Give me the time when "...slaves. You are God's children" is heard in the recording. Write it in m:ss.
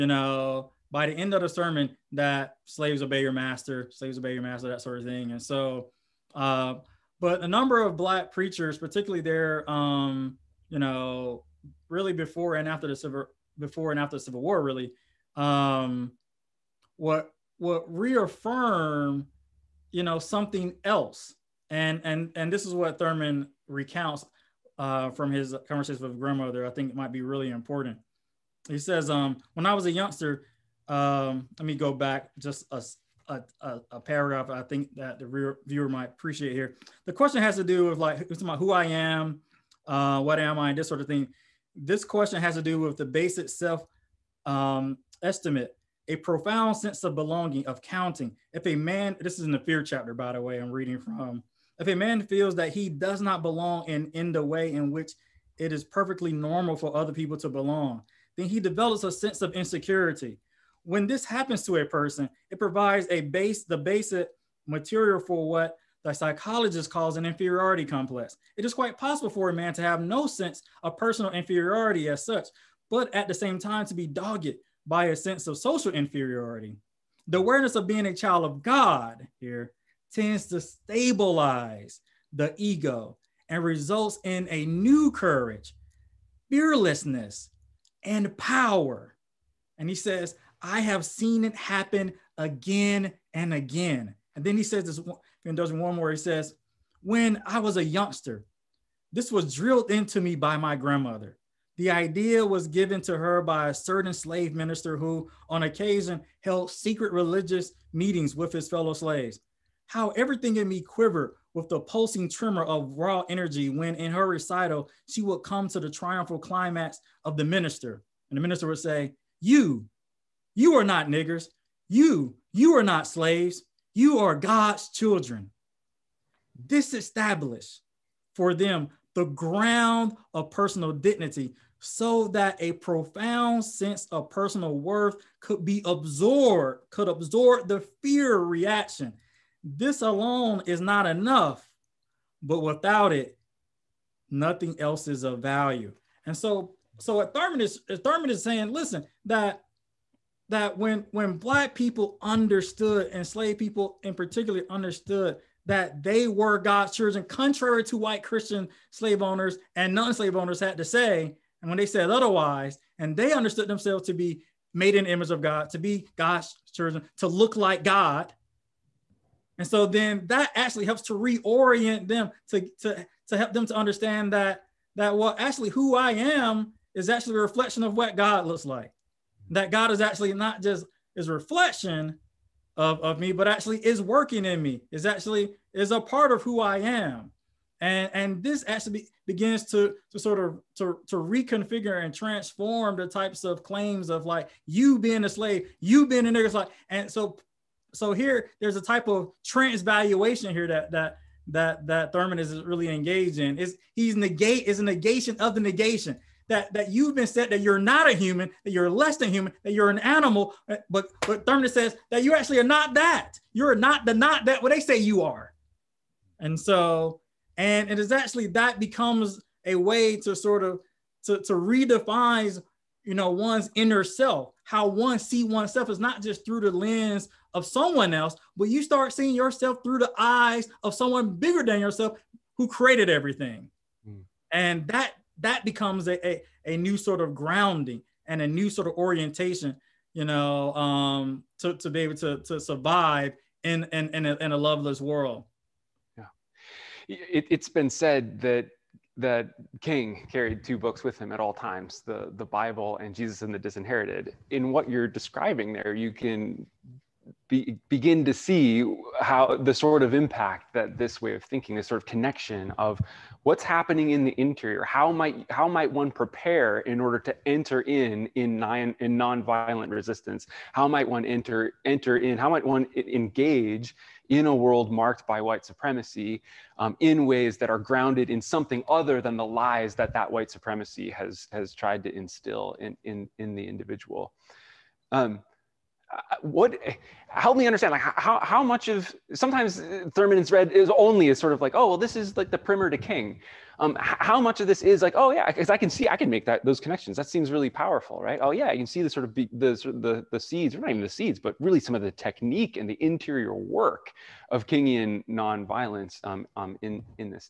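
2:03.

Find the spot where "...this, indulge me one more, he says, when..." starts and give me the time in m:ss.
1:34.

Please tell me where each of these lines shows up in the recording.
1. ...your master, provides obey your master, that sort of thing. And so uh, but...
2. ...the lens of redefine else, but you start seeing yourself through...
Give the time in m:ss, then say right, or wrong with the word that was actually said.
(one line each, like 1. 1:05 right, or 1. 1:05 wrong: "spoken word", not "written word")
1. 0:03 wrong: "slaves", not "provides"
2. 3:46 wrong: "someone", not "redefine".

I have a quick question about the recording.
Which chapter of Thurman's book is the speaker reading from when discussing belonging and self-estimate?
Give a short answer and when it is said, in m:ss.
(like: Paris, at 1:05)
The fear chapter, at 0:49.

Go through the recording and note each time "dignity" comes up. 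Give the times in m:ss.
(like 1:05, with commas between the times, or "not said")
2:10.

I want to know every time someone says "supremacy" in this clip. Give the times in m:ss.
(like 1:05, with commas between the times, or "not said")
4:35, 4:40.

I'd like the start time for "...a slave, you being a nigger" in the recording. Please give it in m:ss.
3:15.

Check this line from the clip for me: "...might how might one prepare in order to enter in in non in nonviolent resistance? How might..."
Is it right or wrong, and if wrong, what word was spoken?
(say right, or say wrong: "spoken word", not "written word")
right.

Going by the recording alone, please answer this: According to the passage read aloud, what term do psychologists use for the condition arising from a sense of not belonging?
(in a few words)
Inferiority complex.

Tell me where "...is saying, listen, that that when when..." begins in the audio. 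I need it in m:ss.
2:28.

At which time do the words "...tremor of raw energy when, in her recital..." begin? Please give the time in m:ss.
1:52.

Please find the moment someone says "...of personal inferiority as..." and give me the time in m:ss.
1:10.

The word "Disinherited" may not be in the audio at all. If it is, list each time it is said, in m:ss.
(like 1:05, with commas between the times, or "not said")
4:13.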